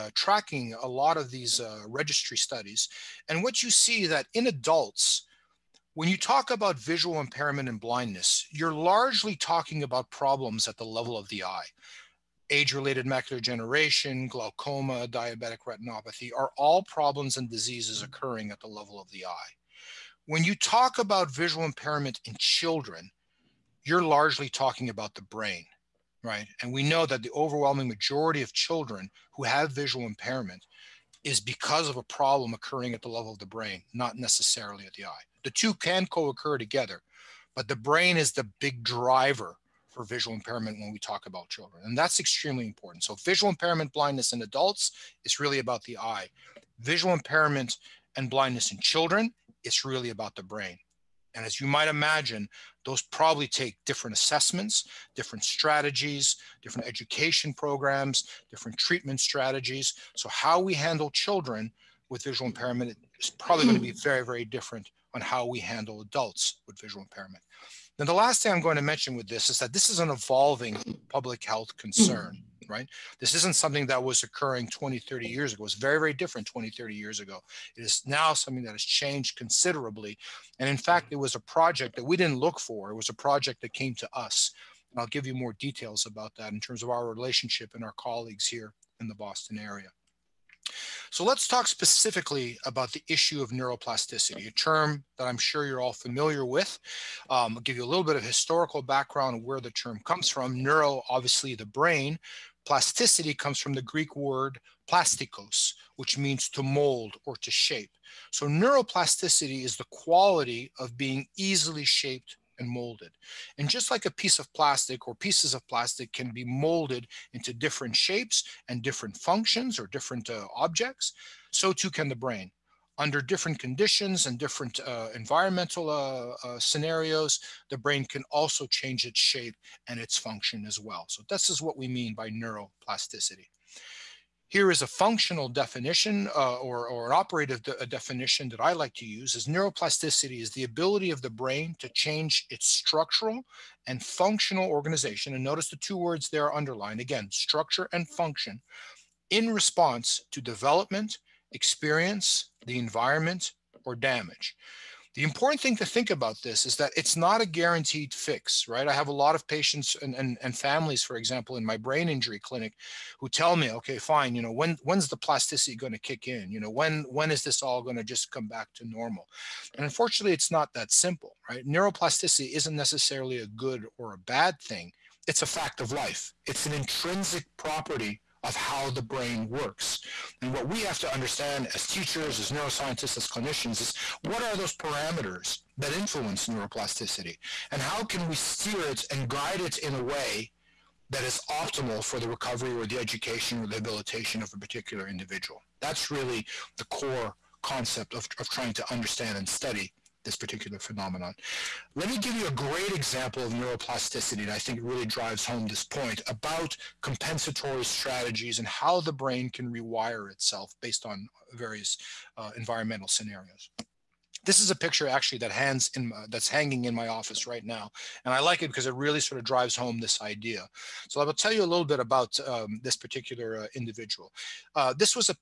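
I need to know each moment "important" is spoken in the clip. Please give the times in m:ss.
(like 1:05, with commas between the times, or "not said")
0:42, 2:35.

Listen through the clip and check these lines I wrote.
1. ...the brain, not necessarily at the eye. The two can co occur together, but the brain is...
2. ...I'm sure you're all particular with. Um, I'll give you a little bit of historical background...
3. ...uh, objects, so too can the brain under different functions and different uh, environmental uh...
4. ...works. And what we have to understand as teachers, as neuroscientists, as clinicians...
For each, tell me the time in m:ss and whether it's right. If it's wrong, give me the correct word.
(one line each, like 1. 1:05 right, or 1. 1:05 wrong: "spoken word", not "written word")
1. 0:33 right
2. 1:35 wrong: "familiar", not "particular"
3. 2:00 wrong: "conditions", not "functions"
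4. 2:59 right.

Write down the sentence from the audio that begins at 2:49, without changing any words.
And unfortunately, it's not that simple, right?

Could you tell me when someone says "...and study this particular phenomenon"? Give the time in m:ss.
3:19.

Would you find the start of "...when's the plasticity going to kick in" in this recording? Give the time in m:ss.
2:44.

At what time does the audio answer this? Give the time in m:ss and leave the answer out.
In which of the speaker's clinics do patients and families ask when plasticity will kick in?
2:41.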